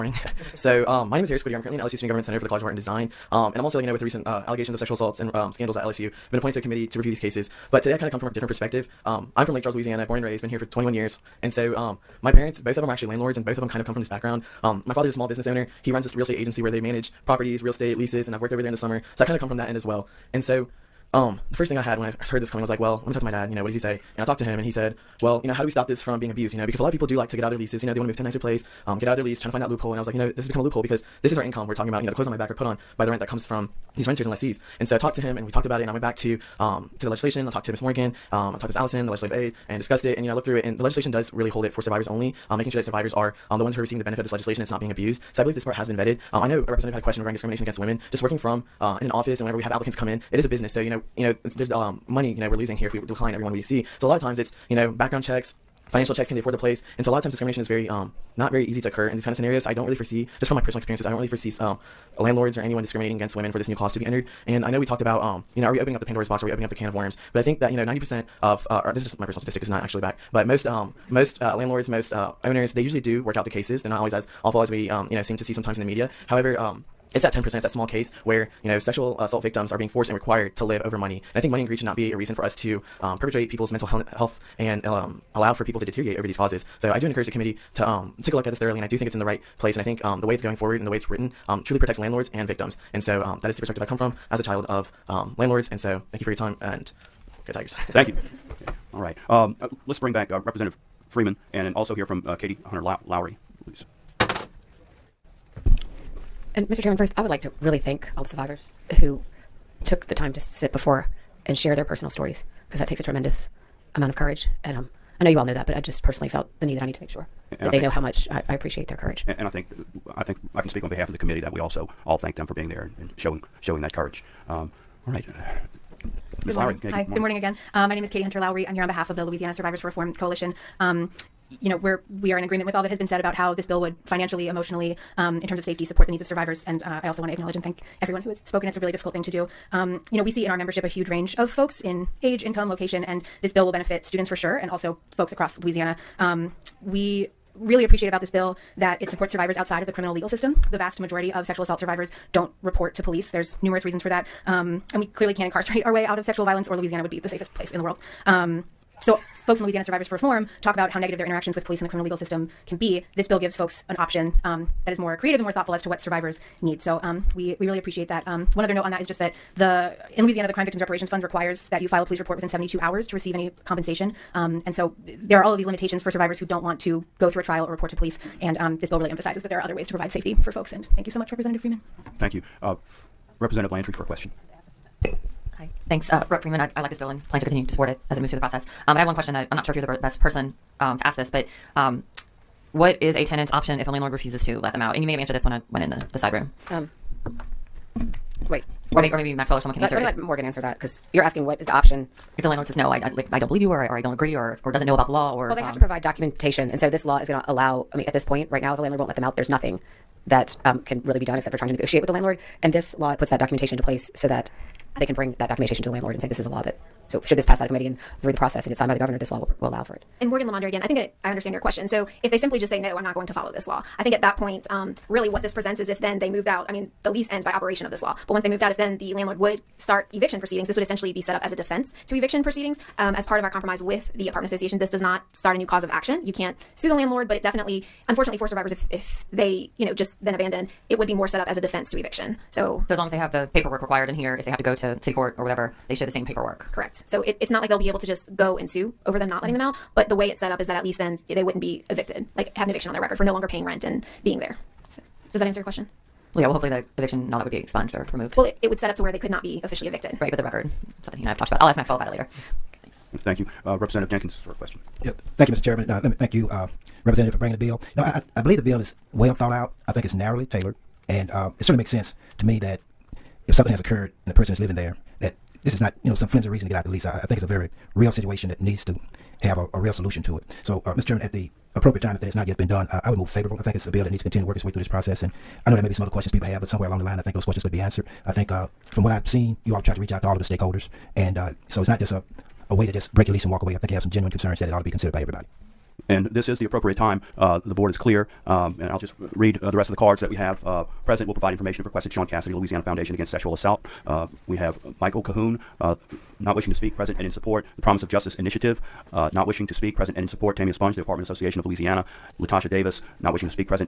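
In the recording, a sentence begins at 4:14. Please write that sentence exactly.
So, does that answer your question?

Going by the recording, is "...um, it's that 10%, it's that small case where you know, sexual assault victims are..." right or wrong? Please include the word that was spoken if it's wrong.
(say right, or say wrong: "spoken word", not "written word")
right.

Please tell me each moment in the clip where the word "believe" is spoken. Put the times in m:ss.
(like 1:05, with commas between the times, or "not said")
0:45, 3:23, 4:28.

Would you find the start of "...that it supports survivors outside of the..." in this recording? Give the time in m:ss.
2:28.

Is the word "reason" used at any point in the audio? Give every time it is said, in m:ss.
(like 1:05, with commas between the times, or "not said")
1:22, 2:33, 4:36.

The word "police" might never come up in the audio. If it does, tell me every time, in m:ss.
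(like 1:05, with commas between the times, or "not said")
2:33, 2:41, 2:52, 2:57.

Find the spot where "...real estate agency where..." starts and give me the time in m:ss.
0:16.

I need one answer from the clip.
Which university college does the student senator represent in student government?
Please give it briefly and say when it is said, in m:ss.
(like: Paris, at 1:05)
College of Art and Design, at 0:02.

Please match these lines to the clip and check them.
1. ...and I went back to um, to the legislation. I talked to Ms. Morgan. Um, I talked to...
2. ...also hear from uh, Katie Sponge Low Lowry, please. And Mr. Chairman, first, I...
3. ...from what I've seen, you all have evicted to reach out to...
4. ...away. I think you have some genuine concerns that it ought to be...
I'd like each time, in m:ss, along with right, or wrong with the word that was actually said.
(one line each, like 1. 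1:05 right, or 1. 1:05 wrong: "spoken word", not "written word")
1. 0:35 right
2. 1:41 wrong: "Hunter", not "Sponge"
3. 4:48 wrong: "tried", not "evicted"
4. 4:53 right.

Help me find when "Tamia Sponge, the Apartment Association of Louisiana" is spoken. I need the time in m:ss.
5:10.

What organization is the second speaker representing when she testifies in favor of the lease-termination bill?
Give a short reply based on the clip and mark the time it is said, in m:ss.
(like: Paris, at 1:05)
Louisiana Survivors for Reform Coalition, at 2:09.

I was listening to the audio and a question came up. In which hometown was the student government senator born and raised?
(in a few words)
Lake Charles.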